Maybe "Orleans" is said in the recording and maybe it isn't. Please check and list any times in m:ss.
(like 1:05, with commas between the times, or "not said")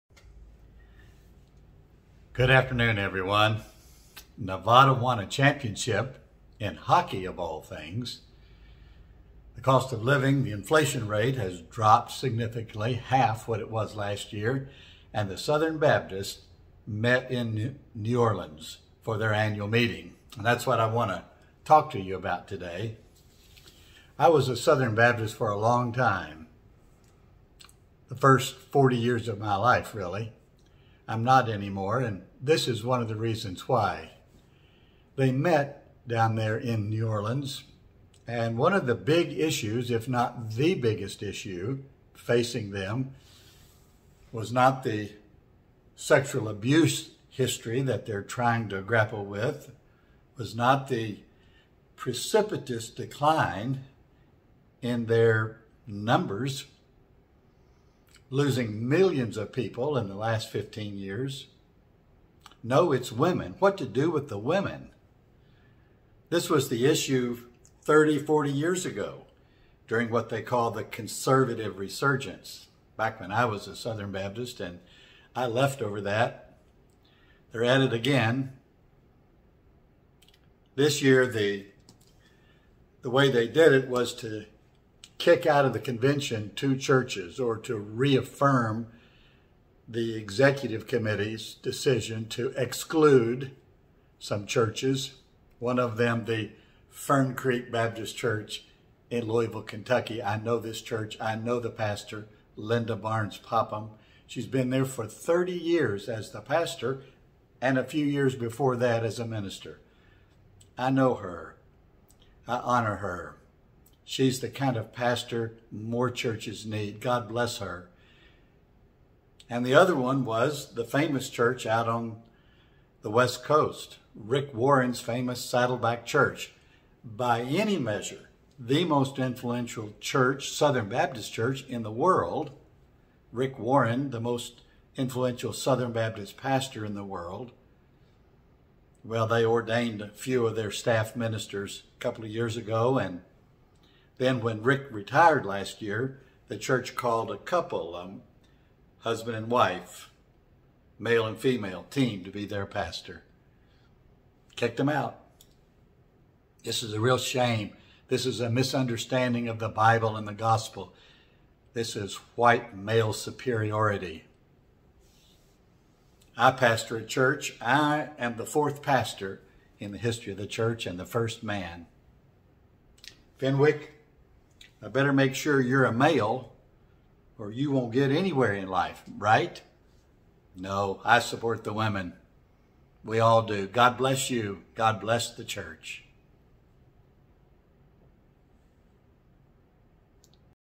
0:18, 0:37.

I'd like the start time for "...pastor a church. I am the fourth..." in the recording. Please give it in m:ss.
2:46.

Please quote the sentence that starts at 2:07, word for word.
By any measure, the most influential church, Southern Baptist church in the world.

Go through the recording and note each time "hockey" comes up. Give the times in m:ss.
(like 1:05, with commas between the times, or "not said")
0:06.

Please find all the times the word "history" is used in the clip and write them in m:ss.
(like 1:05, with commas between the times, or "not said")
0:47, 2:49.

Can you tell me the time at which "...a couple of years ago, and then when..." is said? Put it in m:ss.
2:21.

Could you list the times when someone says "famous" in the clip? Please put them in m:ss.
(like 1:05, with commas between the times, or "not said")
2:00, 2:05.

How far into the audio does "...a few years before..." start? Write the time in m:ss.
1:47.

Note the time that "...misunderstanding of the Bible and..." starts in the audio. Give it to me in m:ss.
2:38.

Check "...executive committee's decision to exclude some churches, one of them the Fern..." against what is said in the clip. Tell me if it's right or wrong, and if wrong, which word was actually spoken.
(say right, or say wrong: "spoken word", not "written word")
right.